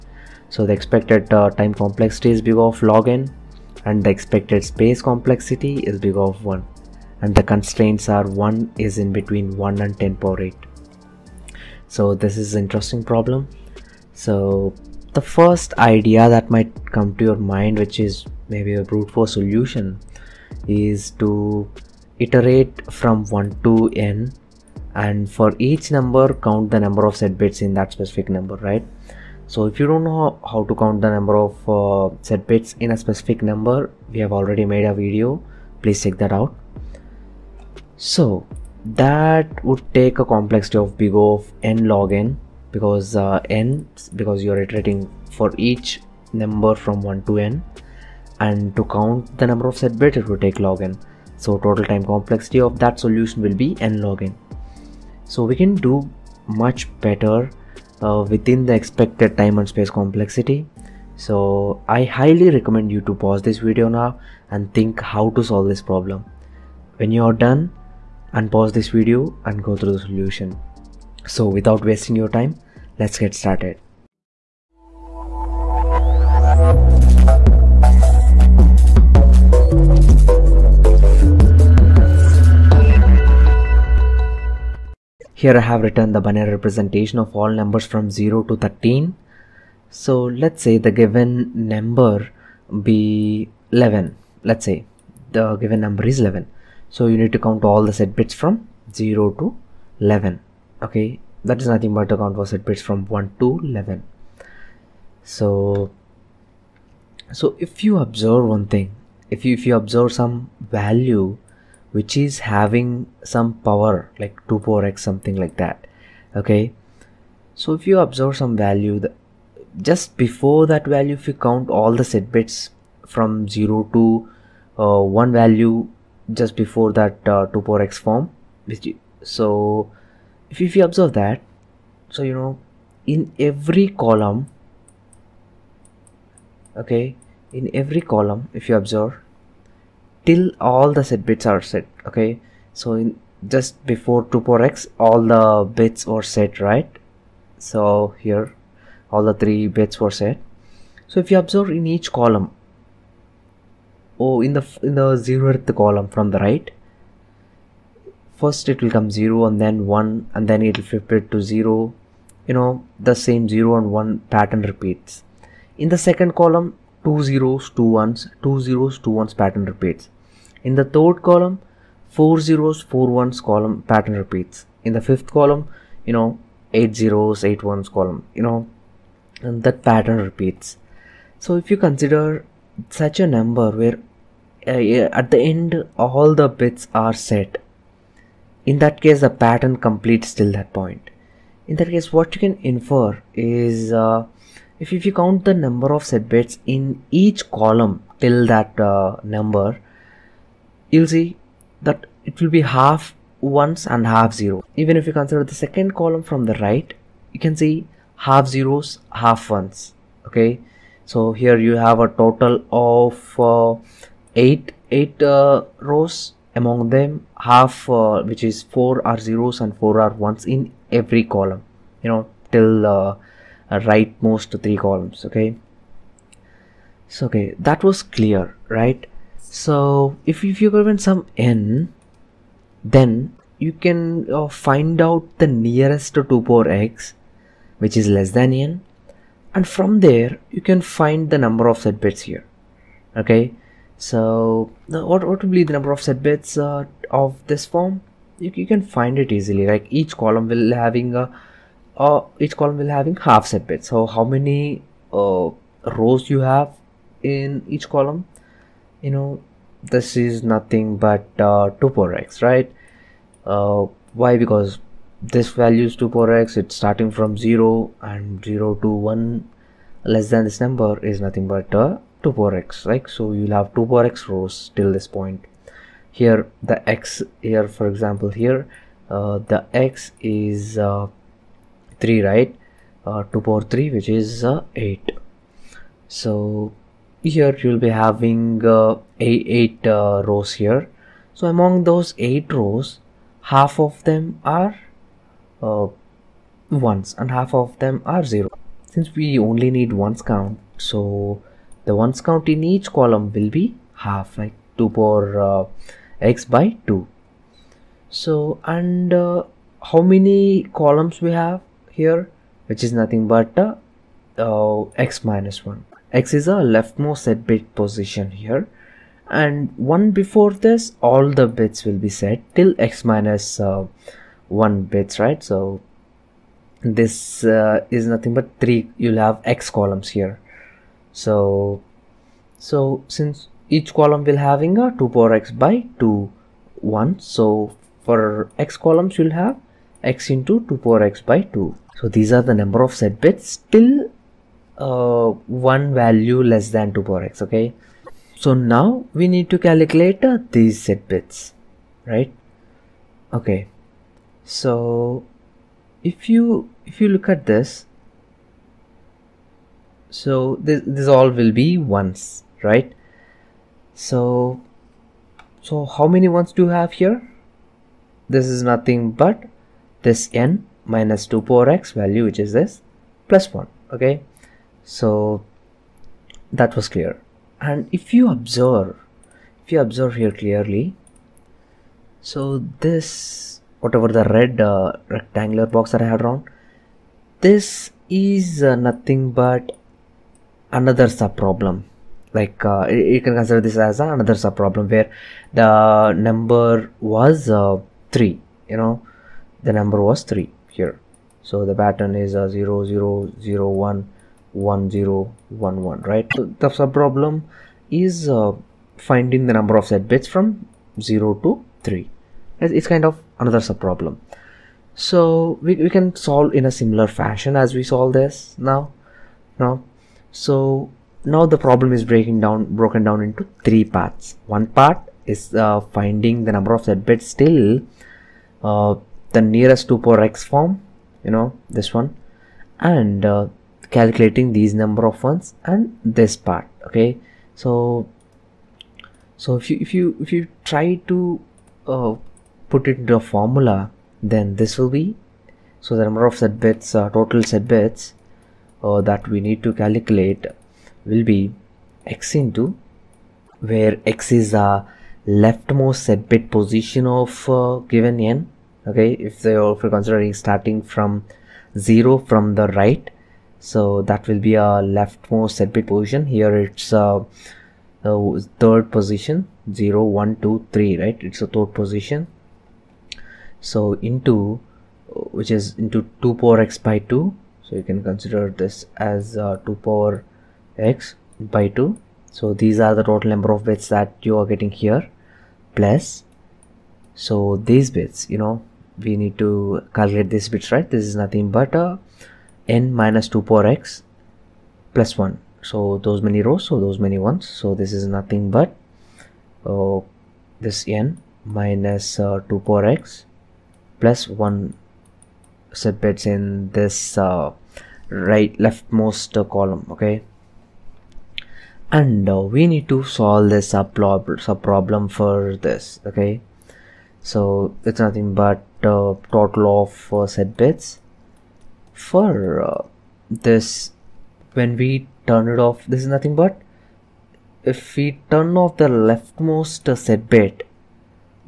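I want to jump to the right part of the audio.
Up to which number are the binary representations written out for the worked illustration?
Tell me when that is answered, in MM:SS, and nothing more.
01:28.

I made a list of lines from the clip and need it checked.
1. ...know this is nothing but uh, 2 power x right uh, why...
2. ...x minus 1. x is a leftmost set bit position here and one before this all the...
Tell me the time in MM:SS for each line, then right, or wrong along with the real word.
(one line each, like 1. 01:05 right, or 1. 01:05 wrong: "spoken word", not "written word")
1. 04:19 right
2. 05:15 right.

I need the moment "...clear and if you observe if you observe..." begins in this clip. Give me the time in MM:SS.
06:16.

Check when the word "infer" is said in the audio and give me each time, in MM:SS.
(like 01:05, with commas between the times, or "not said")
03:12.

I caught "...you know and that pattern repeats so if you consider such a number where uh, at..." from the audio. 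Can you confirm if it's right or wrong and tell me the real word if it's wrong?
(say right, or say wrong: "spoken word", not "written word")
right.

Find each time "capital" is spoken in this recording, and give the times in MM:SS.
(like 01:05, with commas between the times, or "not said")
not said.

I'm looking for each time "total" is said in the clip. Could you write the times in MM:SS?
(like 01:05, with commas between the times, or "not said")
00:51, 03:32, 07:27, 08:03, 08:39.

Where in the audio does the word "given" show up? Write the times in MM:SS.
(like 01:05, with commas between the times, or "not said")
01:30, 01:35, 03:50, 07:37.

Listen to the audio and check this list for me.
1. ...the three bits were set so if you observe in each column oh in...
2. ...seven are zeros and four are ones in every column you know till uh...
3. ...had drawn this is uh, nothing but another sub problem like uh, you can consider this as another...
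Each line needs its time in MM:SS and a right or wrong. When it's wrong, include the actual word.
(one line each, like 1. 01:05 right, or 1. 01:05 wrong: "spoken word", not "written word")
1. 02:29 right
2. 03:38 wrong: "four", not "seven"
3. 06:26 right.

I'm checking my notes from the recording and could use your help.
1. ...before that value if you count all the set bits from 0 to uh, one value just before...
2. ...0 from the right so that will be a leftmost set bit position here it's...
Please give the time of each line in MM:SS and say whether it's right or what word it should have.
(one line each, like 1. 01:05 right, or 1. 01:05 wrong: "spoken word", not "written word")
1. 02:00 right
2. 07:41 right.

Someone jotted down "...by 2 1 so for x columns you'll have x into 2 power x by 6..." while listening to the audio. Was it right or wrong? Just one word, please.
wrong.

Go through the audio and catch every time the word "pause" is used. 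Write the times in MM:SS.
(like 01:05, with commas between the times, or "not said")
01:03, 01:08.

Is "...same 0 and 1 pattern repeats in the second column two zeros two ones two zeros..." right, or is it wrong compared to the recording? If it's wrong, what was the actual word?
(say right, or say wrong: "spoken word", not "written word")
right.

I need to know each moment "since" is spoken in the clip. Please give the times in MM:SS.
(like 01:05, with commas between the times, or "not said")
04:58, 05:33.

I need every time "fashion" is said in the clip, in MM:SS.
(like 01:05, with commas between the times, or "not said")
06:57.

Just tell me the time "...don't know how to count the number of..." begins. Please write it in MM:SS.
00:29.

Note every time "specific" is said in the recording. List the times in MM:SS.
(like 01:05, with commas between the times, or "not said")
00:27, 00:33.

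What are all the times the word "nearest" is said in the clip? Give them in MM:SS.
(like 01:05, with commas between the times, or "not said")
03:55, 07:09.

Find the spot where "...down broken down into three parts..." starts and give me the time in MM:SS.
07:02.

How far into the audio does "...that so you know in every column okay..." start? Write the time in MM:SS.
02:11.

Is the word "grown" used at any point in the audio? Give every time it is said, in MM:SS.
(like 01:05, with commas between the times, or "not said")
not said.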